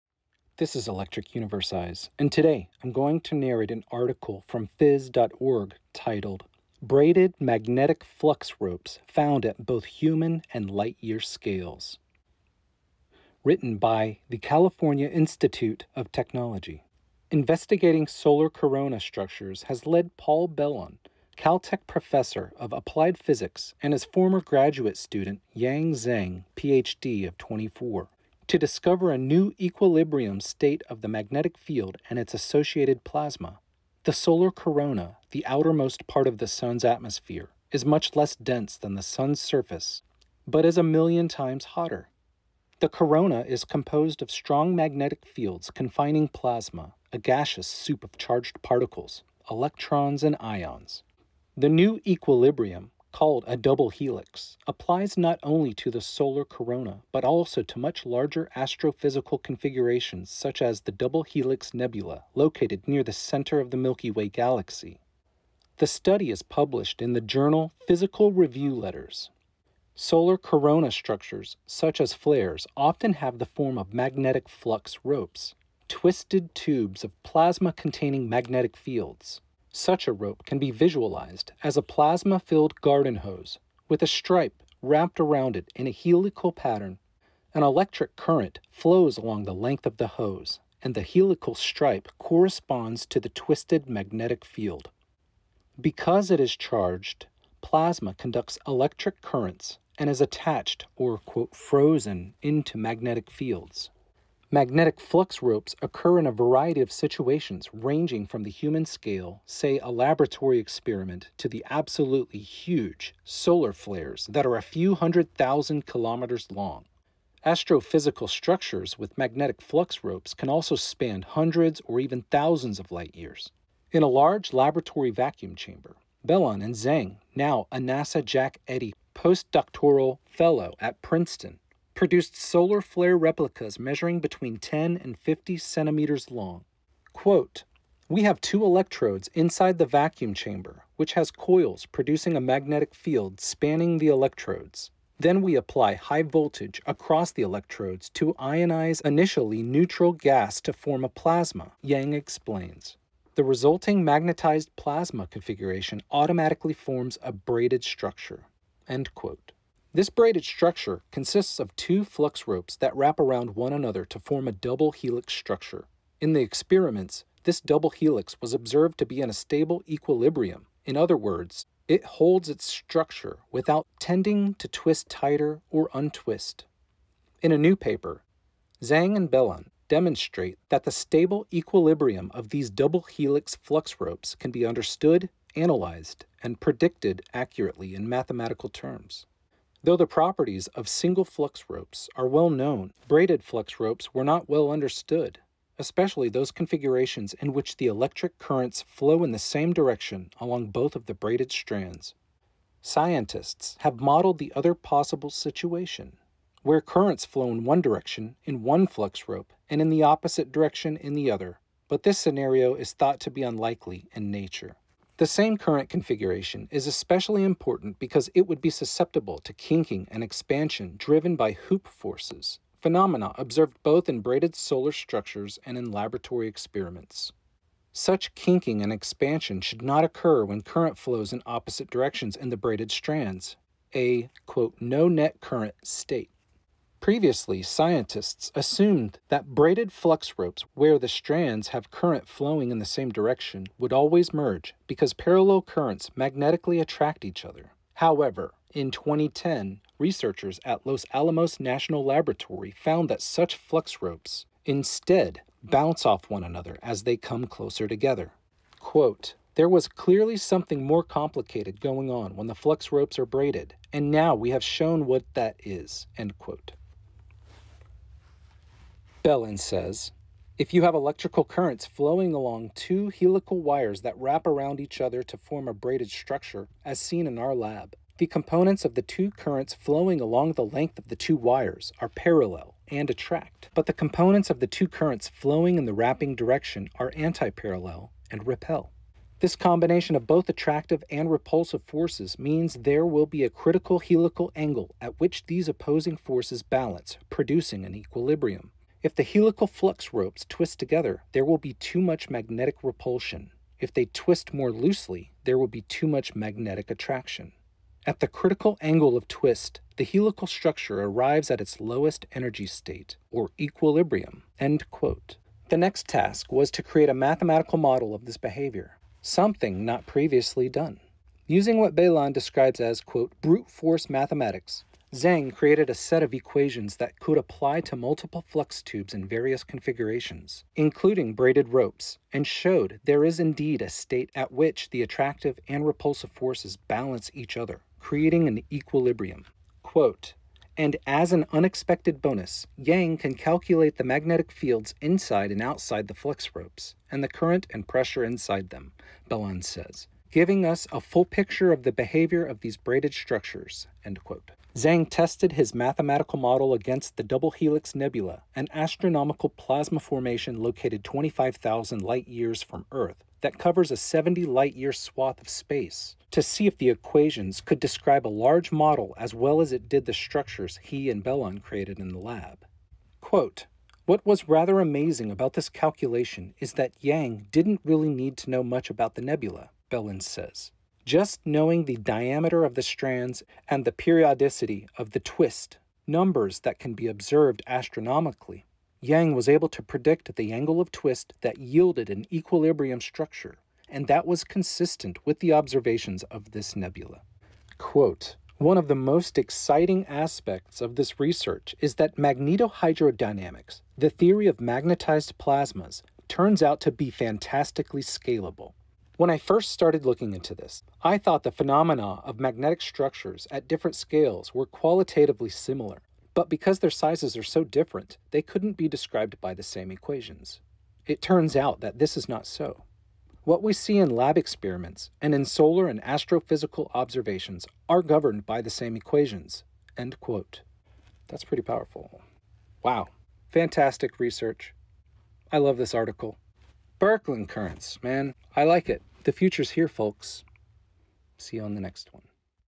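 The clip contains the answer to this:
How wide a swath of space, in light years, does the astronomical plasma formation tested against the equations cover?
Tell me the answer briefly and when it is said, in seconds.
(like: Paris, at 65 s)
70 light years, at 363 s.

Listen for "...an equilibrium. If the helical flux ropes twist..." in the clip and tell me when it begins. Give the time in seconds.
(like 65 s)
297 s.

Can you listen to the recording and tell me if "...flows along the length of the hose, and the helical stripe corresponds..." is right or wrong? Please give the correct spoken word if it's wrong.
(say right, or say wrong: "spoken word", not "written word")
right.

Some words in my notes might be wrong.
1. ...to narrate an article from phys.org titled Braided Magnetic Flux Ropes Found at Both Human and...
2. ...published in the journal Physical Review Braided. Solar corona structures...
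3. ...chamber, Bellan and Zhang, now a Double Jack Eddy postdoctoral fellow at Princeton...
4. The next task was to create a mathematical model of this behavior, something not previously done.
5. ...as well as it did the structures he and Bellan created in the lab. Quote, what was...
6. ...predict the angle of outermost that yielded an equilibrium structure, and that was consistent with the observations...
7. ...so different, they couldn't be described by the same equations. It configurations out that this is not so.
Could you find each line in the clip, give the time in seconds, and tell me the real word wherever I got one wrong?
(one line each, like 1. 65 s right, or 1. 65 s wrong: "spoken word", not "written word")
1. 3 s right
2. 66 s wrong: "Letters", not "Braided"
3. 125 s wrong: "NASA", not "Double"
4. 314 s right
5. 369 s right
6. 389 s wrong: "twist", not "outermost"
7. 417 s wrong: "turns", not "configurations".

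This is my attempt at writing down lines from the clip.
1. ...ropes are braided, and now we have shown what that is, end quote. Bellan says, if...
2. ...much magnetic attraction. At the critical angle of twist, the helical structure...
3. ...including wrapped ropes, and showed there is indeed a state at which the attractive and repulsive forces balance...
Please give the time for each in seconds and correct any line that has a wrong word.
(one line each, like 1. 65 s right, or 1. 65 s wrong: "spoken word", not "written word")
1. 262 s right
2. 306 s right
3. 330 s wrong: "braided", not "wrapped".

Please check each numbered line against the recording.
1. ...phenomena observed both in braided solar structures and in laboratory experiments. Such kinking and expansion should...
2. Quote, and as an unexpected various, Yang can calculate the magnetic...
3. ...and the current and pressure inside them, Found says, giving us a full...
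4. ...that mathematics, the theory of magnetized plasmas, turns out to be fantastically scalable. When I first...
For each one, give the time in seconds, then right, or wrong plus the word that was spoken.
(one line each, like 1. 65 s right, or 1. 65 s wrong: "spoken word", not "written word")
1. 222 s right
2. 339 s wrong: "bonus", not "various"
3. 347 s wrong: "Bellan", not "Found"
4. 401 s wrong: "magnetohydrodynamics", not "mathematics".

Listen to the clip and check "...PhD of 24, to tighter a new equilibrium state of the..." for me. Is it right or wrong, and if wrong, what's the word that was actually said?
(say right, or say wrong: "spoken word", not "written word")
wrong: "discover", not "tighter".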